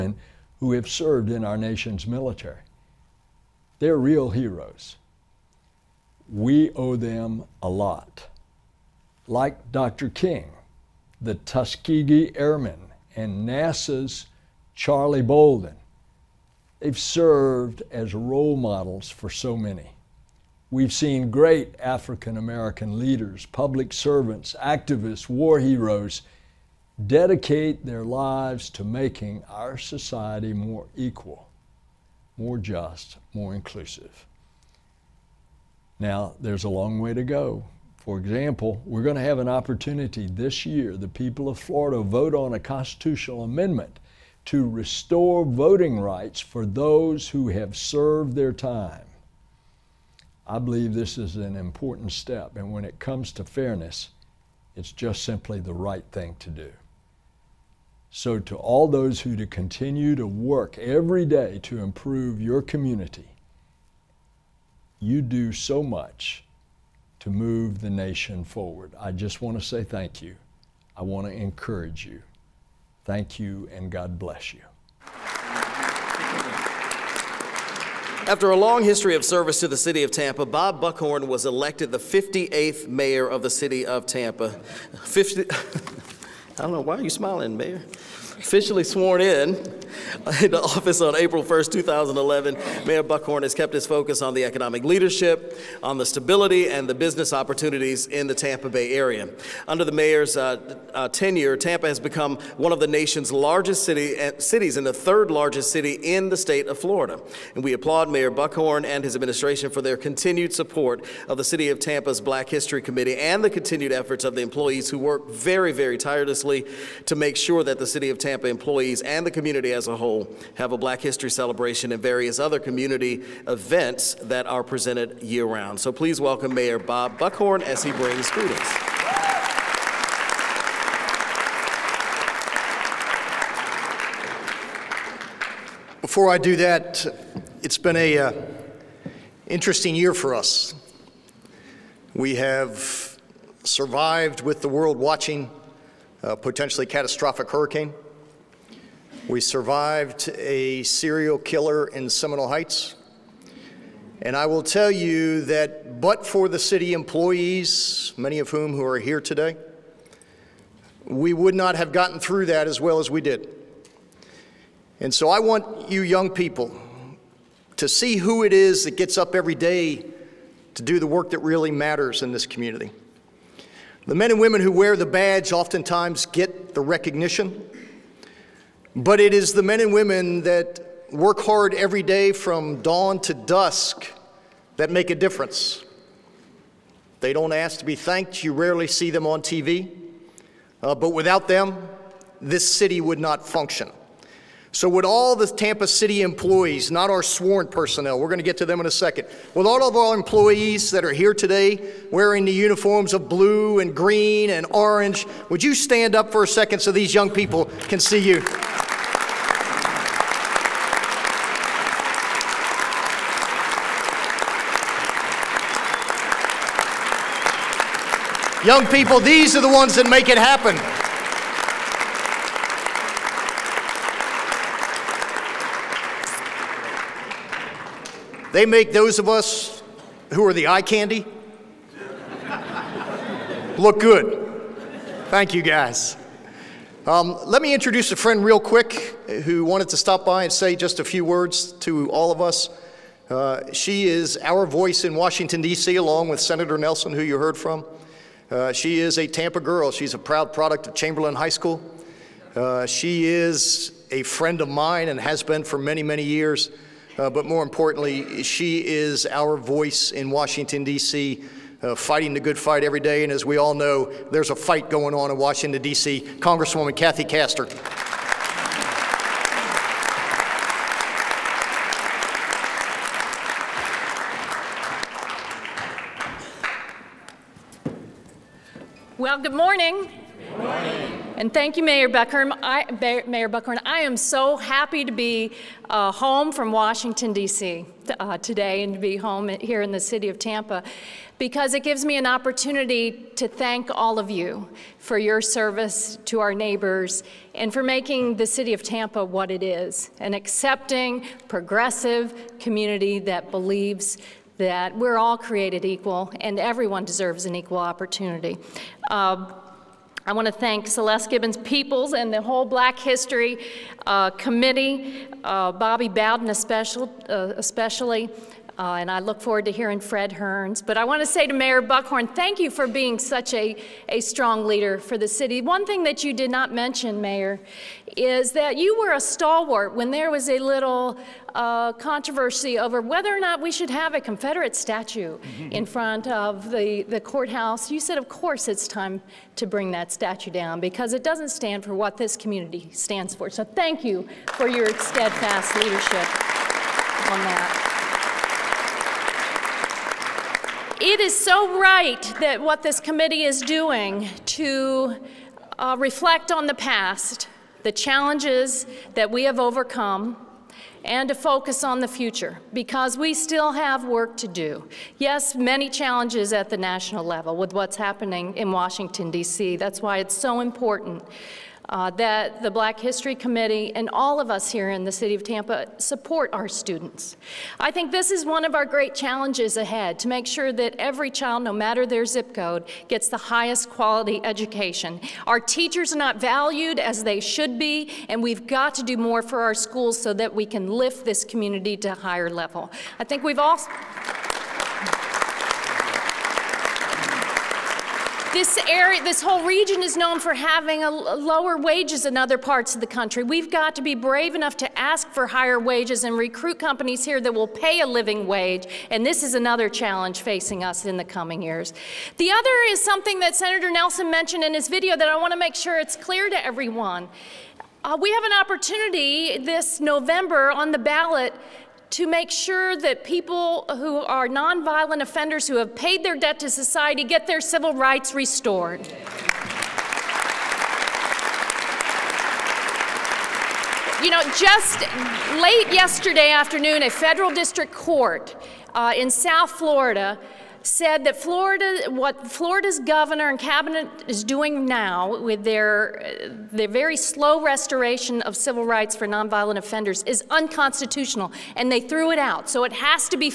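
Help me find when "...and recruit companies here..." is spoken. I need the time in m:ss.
6:46.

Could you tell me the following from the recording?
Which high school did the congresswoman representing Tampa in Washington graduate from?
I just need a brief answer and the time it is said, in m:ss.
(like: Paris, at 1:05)
Chamberlain High School, at 4:10.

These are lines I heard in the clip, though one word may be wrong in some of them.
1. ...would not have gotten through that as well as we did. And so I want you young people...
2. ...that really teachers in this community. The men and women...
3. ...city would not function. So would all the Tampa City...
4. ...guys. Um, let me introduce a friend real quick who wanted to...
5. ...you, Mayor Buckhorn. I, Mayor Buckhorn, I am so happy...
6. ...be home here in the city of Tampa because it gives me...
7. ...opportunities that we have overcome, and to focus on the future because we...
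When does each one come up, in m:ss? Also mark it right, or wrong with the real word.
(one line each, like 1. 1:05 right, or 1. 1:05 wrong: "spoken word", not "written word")
1. 2:41 right
2. 2:51 wrong: "matters", not "teachers"
3. 3:12 right
4. 3:55 right
5. 4:41 right
6. 4:48 right
7. 5:57 wrong: "challenges", not "opportunities".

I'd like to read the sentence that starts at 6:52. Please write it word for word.
The other is something that Senator Nelson mentioned in his video that I want to make sure it's clear to everyone.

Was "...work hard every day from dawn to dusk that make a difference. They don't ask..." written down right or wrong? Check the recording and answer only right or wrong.
right.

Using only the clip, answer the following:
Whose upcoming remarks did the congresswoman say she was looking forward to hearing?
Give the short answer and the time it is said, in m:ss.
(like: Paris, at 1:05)
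Fred Hearns, at 5:19.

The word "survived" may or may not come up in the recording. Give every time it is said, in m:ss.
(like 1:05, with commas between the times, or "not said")
2:23, 2:29.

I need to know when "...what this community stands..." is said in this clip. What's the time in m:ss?
5:41.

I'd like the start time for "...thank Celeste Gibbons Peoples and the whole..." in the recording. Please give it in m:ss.
5:10.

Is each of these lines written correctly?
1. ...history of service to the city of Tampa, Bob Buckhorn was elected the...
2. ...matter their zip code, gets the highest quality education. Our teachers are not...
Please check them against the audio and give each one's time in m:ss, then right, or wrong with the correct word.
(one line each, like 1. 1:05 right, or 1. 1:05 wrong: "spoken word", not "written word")
1. 1:18 right
2. 6:21 right.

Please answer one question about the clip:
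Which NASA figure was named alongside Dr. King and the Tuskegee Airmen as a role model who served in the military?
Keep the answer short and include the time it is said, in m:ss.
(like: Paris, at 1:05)
Charlie Bolden, at 0:14.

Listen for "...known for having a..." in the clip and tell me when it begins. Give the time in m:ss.
6:40.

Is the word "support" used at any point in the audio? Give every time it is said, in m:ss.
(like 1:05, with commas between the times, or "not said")
1:50, 6:15.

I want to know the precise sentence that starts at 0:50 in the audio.
I believe this is an important step, and when it comes to fairness, it's just simply the right thing to do.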